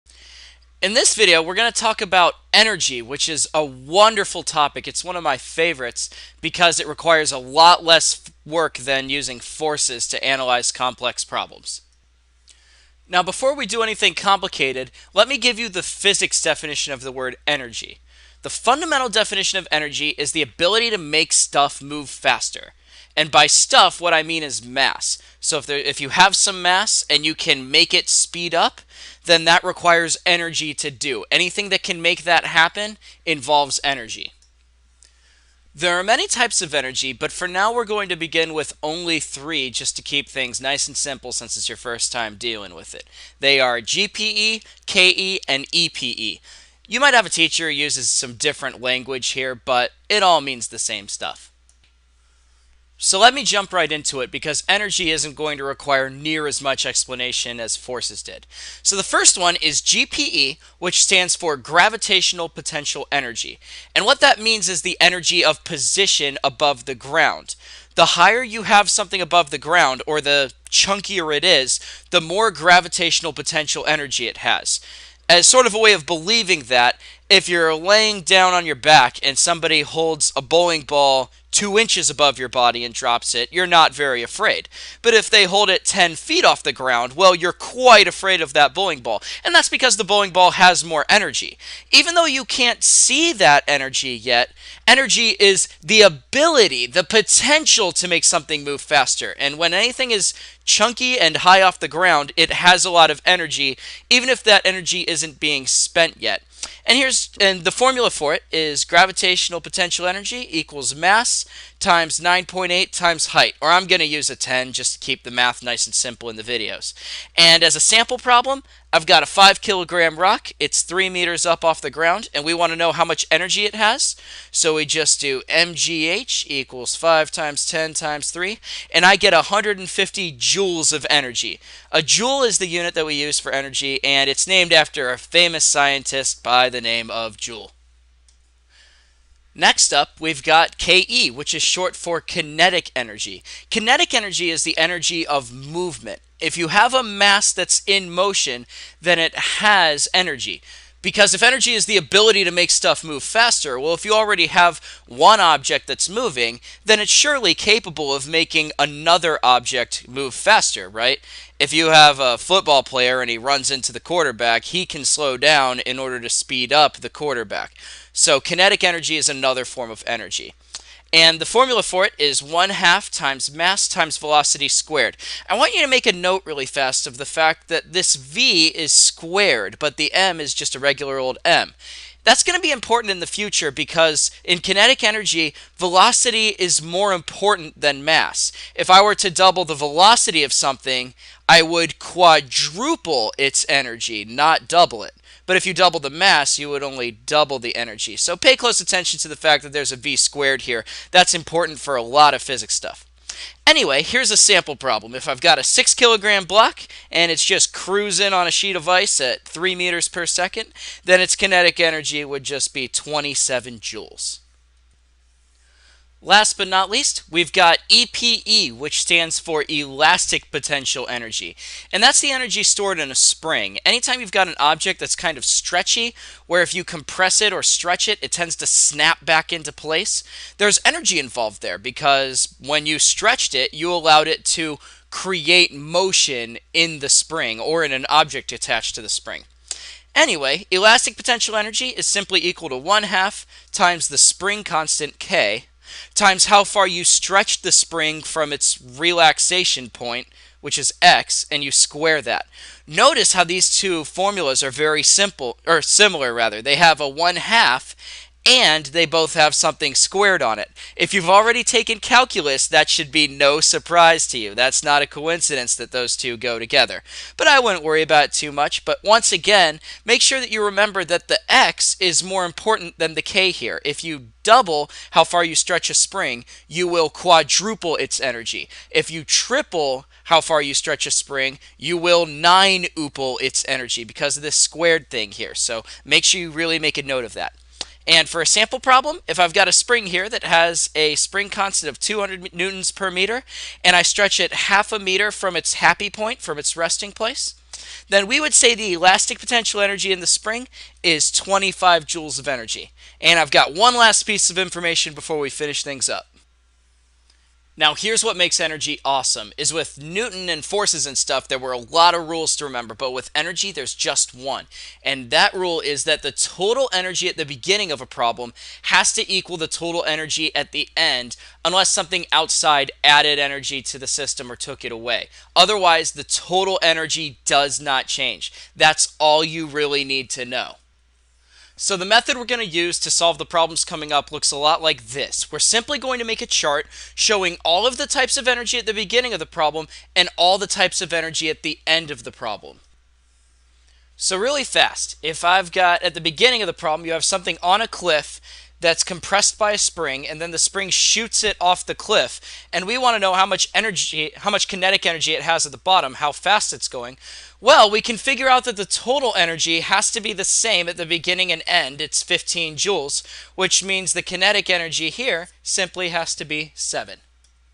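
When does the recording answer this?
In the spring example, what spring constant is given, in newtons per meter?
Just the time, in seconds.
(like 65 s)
291 s.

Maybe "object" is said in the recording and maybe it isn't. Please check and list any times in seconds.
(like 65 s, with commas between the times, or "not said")
155 s, 159 s, 224 s, 238 s.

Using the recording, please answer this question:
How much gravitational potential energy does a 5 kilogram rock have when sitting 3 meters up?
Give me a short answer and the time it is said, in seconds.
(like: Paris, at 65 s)
150 joules, at 129 s.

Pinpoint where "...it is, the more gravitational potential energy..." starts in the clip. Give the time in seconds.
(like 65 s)
71 s.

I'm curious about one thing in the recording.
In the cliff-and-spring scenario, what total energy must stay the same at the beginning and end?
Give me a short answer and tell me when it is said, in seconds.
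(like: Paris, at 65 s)
15 joules, at 362 s.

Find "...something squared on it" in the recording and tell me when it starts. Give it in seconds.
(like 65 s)
259 s.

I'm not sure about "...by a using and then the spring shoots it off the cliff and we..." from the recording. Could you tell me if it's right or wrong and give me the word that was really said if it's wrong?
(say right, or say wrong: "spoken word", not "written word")
wrong: "spring", not "using".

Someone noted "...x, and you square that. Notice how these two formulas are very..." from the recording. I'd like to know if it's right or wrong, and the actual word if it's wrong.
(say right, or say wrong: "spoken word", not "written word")
right.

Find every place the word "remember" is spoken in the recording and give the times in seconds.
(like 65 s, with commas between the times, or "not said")
270 s, 312 s.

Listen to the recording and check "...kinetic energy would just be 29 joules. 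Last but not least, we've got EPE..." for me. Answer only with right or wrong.
wrong.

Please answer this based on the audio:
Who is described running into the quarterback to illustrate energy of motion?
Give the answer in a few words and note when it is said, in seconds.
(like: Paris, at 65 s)
football player, at 162 s.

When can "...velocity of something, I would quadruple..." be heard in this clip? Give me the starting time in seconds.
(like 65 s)
189 s.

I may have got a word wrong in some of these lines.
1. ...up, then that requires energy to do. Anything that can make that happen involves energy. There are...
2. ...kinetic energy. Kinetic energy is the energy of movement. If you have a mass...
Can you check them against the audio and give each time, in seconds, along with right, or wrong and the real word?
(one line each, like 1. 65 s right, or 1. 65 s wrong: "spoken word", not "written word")
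1. 28 s right
2. 142 s right.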